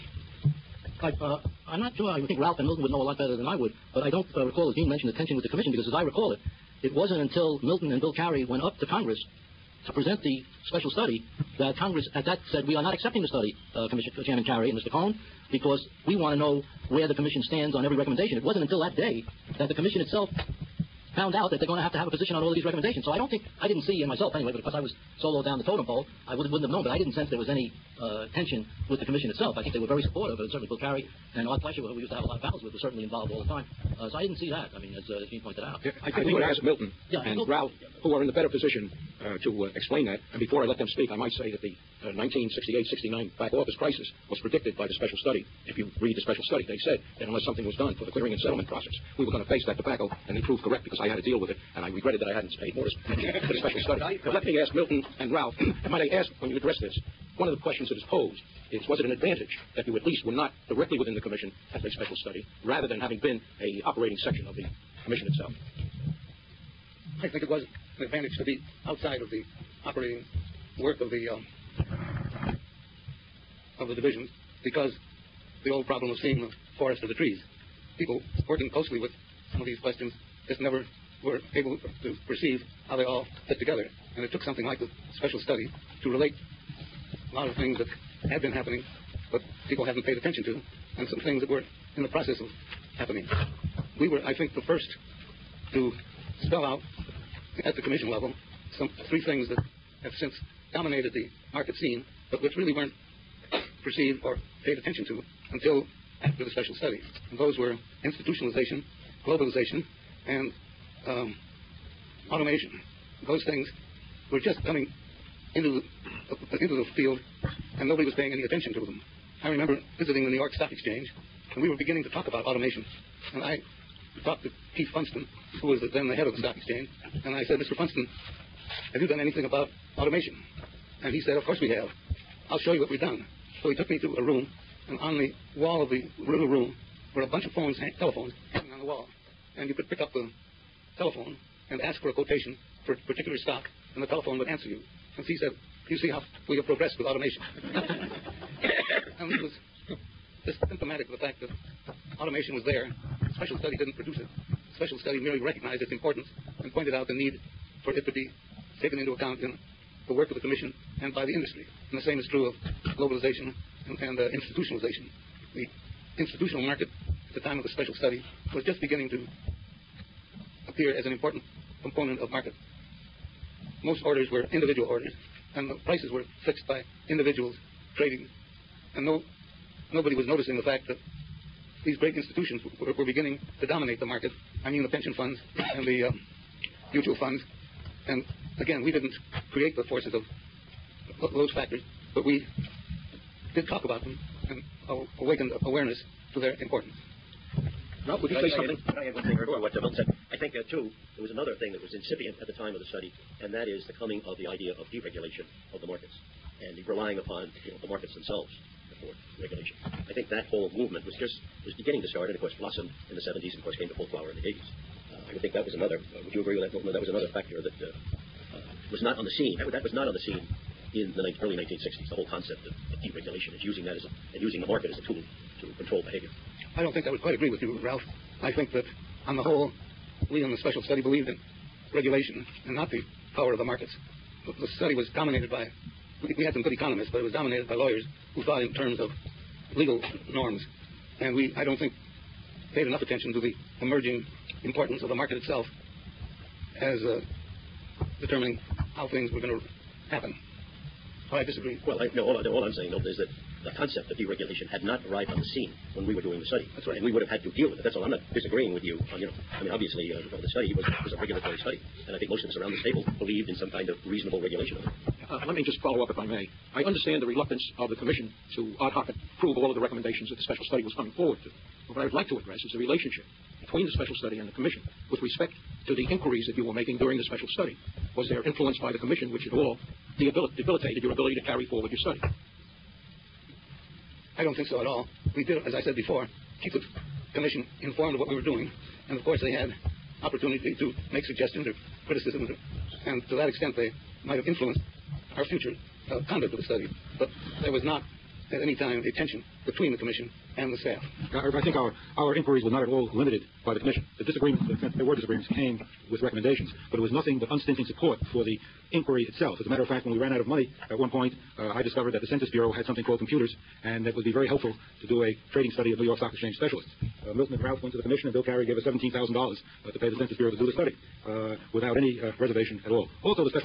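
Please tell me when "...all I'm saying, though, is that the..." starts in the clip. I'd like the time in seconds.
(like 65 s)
252 s.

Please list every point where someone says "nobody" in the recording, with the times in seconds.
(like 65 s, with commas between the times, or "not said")
117 s, 179 s.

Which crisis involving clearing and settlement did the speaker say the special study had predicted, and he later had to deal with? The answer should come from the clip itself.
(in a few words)
1968-69 back office crisis.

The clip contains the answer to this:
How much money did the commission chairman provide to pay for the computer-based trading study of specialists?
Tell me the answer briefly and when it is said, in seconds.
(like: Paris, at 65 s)
$17,000, at 318 s.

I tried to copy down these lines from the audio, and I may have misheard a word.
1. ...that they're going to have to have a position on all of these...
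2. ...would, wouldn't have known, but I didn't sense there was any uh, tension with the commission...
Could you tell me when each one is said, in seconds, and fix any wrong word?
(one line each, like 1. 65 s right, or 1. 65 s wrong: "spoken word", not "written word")
1. 21 s right
2. 26 s right.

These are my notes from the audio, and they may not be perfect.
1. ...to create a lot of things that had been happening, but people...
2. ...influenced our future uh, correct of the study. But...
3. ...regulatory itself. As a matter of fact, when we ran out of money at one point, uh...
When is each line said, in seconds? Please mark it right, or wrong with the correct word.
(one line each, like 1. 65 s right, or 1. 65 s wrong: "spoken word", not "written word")
1. 86 s wrong: "relate", not "create"
2. 294 s wrong: "conduct", not "correct"
3. 308 s wrong: "inquiry", not "regulatory".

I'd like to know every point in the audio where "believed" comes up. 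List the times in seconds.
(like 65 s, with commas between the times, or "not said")
231 s, 263 s.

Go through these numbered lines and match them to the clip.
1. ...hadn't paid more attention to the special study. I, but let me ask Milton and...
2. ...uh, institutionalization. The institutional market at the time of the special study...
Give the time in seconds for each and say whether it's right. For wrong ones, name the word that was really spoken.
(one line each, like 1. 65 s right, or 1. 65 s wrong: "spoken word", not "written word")
1. 52 s right
2. 164 s right.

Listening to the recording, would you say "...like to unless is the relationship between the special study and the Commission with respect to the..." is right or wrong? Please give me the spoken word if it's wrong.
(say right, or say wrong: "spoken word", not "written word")
wrong: "address", not "unless".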